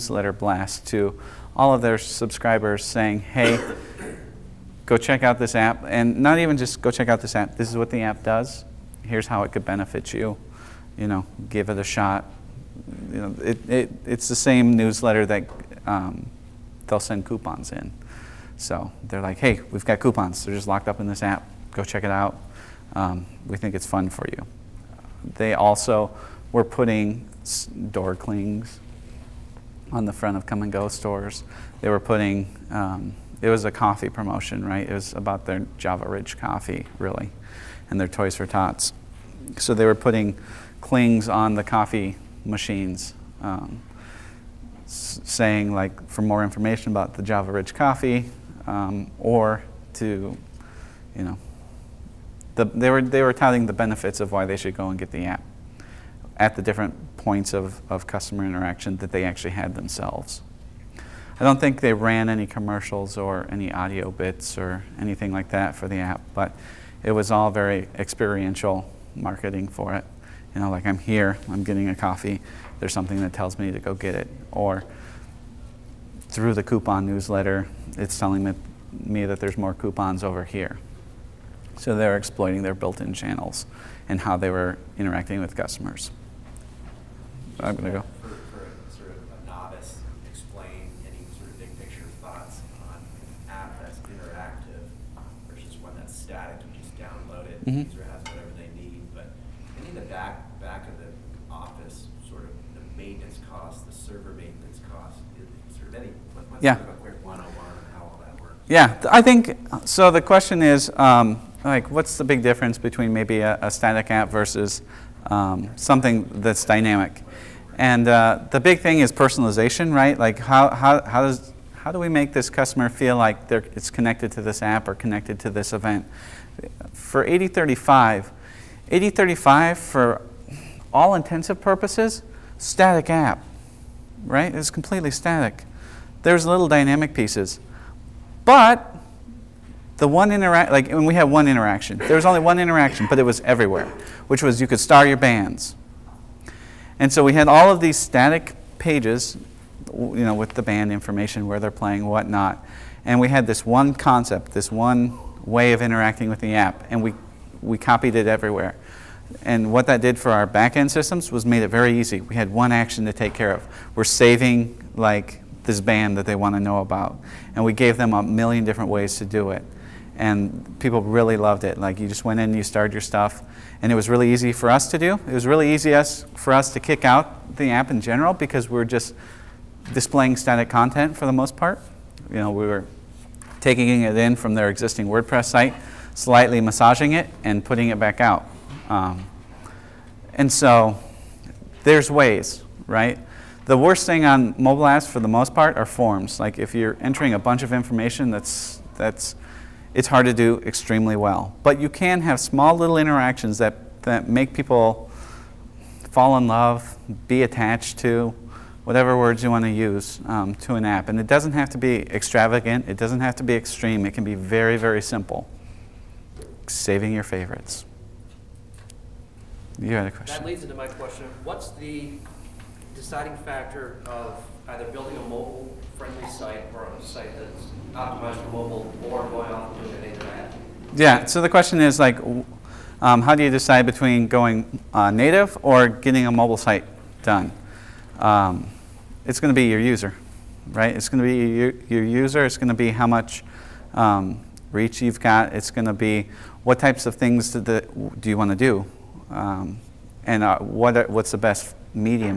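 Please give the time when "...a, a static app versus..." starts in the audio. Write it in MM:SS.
01:53.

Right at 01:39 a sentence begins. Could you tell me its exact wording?
But any of the back back of the office, sort of the maintenance cost, the server maintenance cost, sort of any.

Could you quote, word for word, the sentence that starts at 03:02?
You know, we were taking it in from their existing WordPress site, slightly massaging it, and putting it back out.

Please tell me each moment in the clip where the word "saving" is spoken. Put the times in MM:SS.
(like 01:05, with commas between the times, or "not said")
02:44, 03:36.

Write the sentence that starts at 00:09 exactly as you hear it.
Here's how it could benefit you.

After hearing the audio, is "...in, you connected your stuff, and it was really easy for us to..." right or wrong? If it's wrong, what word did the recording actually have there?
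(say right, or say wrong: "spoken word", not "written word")
wrong: "started", not "connected".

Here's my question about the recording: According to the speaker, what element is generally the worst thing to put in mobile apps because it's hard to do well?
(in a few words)
Forms.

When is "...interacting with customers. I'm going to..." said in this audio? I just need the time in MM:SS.
01:24.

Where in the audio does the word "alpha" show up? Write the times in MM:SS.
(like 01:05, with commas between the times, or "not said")
not said.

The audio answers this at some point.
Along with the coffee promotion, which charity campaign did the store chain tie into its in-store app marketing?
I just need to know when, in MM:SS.
00:38.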